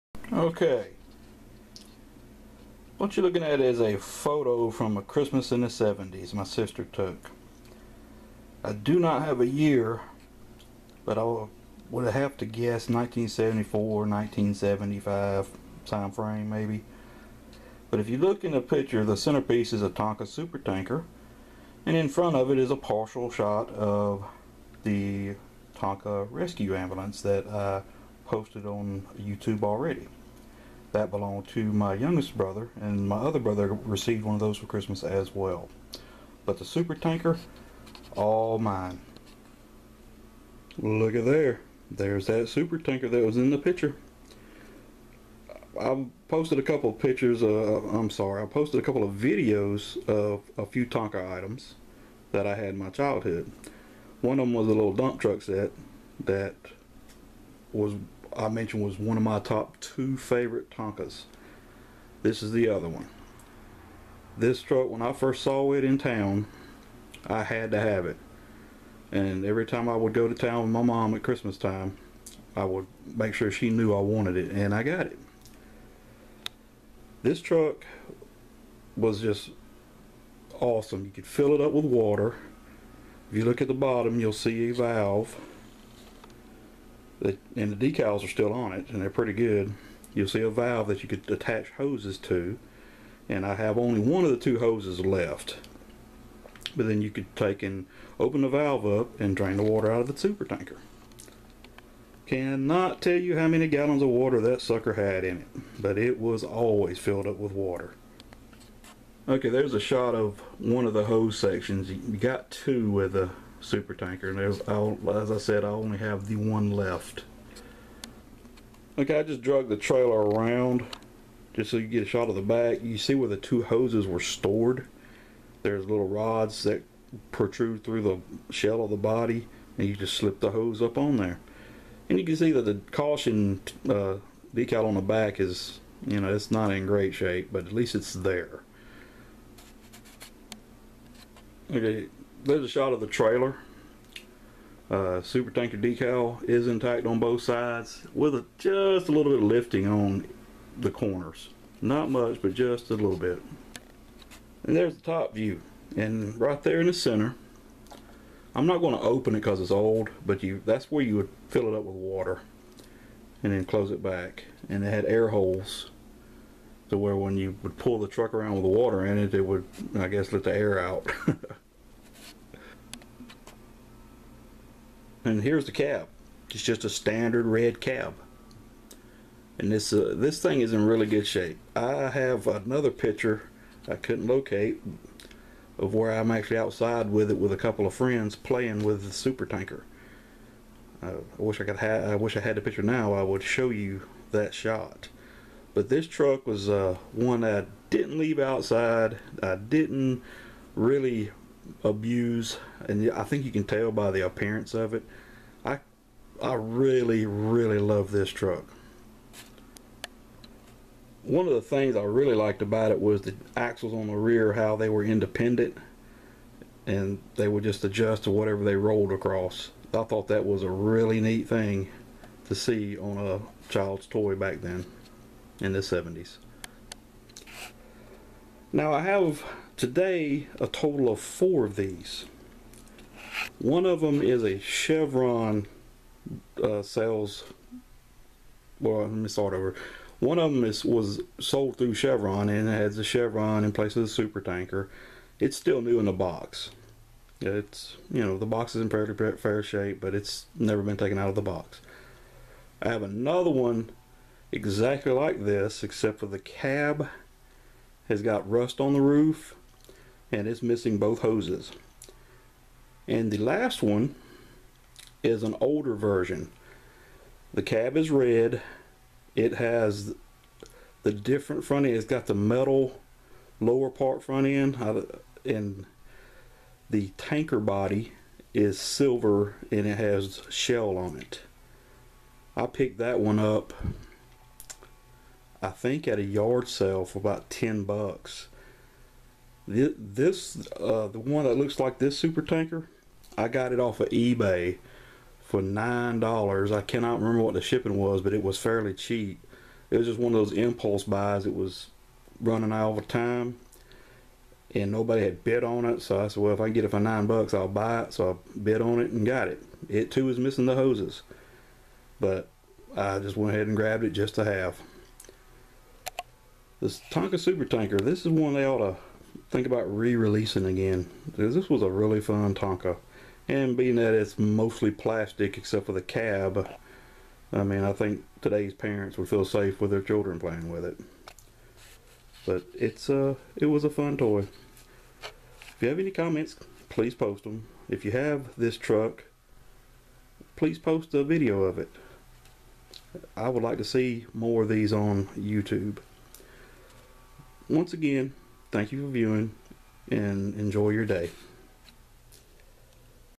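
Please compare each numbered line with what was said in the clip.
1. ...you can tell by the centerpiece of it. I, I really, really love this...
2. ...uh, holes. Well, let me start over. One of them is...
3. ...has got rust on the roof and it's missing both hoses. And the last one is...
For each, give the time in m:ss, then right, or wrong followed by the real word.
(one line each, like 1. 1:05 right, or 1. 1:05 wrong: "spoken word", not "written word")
1. 3:23 wrong: "appearance", not "centerpiece"
2. 3:56 wrong: "sales", not "holes"
3. 4:18 right.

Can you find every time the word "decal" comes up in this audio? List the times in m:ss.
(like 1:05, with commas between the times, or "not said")
1:27, 2:14, 2:25.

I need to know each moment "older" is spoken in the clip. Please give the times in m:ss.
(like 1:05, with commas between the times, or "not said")
4:25.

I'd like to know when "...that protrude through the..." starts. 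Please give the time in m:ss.
2:06.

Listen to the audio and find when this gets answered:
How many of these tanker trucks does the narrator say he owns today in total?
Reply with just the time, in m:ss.
3:50.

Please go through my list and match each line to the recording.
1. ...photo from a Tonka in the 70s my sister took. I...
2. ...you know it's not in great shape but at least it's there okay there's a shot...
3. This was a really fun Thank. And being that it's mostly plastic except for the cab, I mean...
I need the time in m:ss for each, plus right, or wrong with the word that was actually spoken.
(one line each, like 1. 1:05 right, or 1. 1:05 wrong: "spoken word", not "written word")
1. 0:03 wrong: "Christmas", not "Tonka"
2. 2:16 right
3. 5:21 wrong: "Tonka", not "Thank".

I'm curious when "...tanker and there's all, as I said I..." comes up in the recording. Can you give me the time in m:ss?
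1:53.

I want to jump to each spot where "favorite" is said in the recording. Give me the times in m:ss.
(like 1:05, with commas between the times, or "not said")
1:00.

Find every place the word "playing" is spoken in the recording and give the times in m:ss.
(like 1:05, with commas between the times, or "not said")
3:08, 5:30.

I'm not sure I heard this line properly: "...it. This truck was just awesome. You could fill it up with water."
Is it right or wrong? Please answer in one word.
right.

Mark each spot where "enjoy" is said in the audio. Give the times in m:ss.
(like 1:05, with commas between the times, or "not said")
5:50.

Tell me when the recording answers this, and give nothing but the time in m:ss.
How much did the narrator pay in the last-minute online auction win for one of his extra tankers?
4:55.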